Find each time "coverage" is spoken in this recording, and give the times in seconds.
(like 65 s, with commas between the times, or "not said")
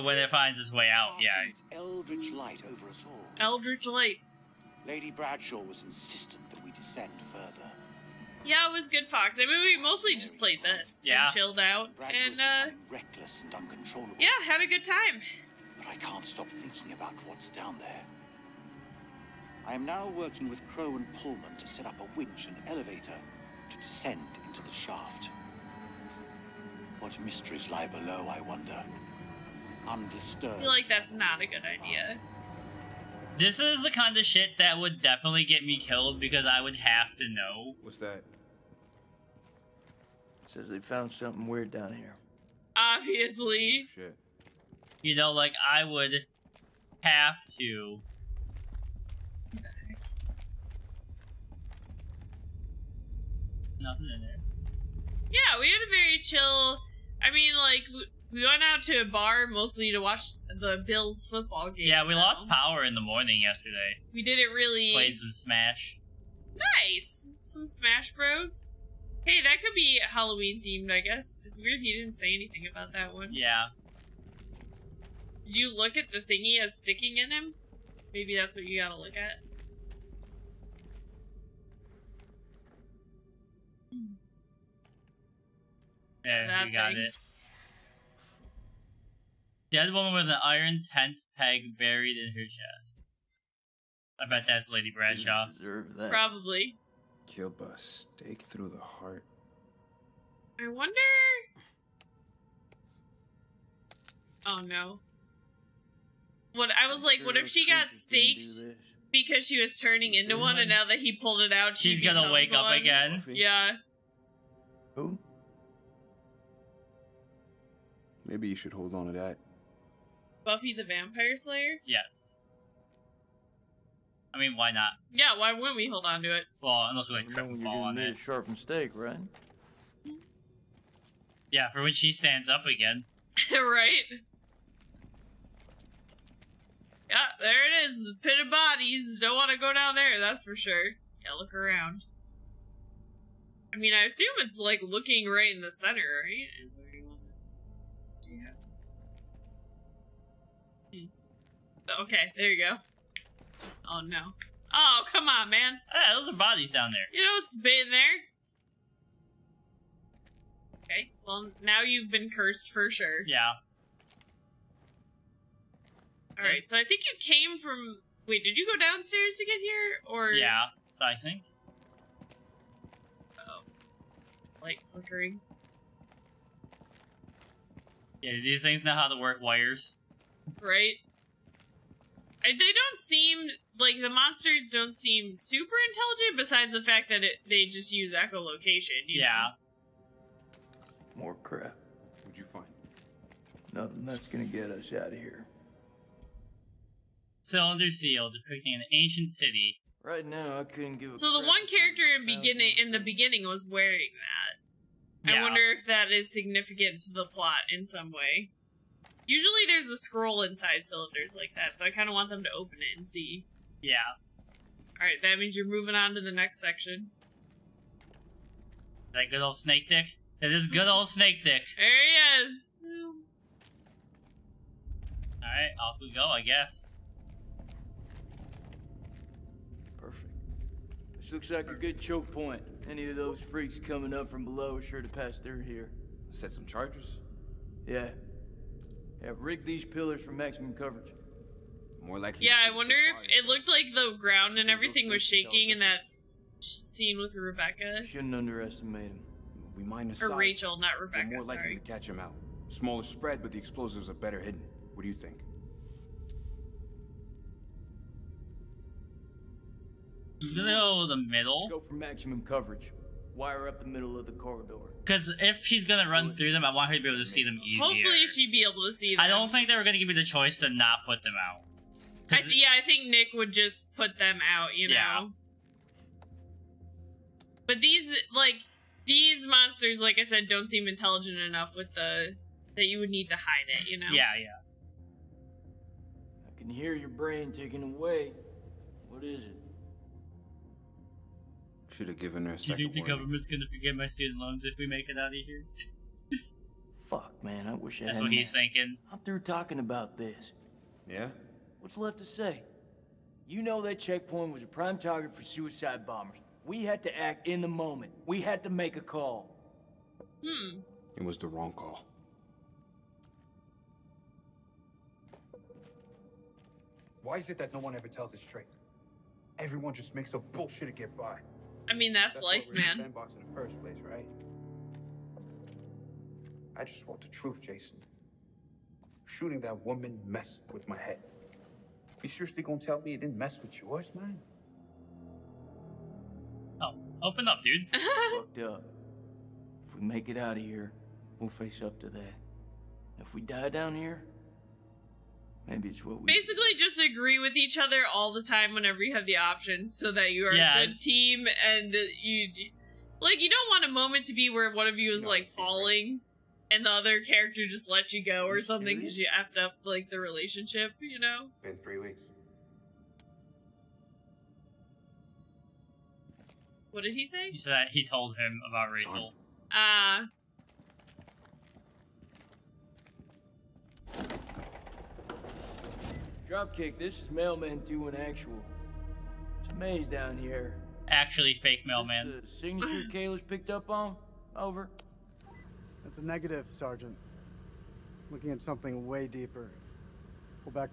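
240 s, 262 s.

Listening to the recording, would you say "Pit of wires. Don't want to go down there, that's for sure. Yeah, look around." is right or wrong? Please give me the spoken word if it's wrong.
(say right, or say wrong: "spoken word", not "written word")
wrong: "bodies", not "wires".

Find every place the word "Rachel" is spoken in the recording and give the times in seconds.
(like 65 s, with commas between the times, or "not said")
250 s, 368 s.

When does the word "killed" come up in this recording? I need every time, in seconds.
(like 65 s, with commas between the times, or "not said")
35 s, 97 s.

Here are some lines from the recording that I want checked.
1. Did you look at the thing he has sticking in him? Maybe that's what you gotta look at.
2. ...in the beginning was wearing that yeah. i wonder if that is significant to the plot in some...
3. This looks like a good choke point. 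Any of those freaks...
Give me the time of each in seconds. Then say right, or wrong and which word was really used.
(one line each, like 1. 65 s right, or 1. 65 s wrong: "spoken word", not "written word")
1. 75 s right
2. 202 s right
3. 231 s right.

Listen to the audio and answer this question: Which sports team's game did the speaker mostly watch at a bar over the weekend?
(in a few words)
Bills.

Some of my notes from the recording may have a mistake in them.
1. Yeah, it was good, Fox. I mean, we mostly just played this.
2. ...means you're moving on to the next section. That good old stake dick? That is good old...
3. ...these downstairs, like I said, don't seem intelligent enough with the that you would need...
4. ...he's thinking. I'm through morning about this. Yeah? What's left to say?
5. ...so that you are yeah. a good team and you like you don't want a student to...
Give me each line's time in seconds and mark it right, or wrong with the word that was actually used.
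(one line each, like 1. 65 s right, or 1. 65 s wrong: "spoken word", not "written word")
1. 8 s right
2. 215 s wrong: "snake", not "stake"
3. 279 s wrong: "monsters", not "downstairs"
4. 298 s wrong: "talking", not "morning"
5. 349 s wrong: "moment", not "student".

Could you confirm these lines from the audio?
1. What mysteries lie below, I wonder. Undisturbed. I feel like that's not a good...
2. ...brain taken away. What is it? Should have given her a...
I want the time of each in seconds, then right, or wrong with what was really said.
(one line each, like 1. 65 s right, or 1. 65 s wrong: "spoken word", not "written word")
1. 26 s right
2. 287 s right.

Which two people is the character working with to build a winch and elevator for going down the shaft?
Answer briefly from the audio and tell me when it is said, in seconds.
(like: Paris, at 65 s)
Crow and Pullman, at 20 s.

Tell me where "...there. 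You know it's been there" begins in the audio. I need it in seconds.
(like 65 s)
156 s.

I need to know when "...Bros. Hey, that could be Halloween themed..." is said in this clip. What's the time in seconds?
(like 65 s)
68 s.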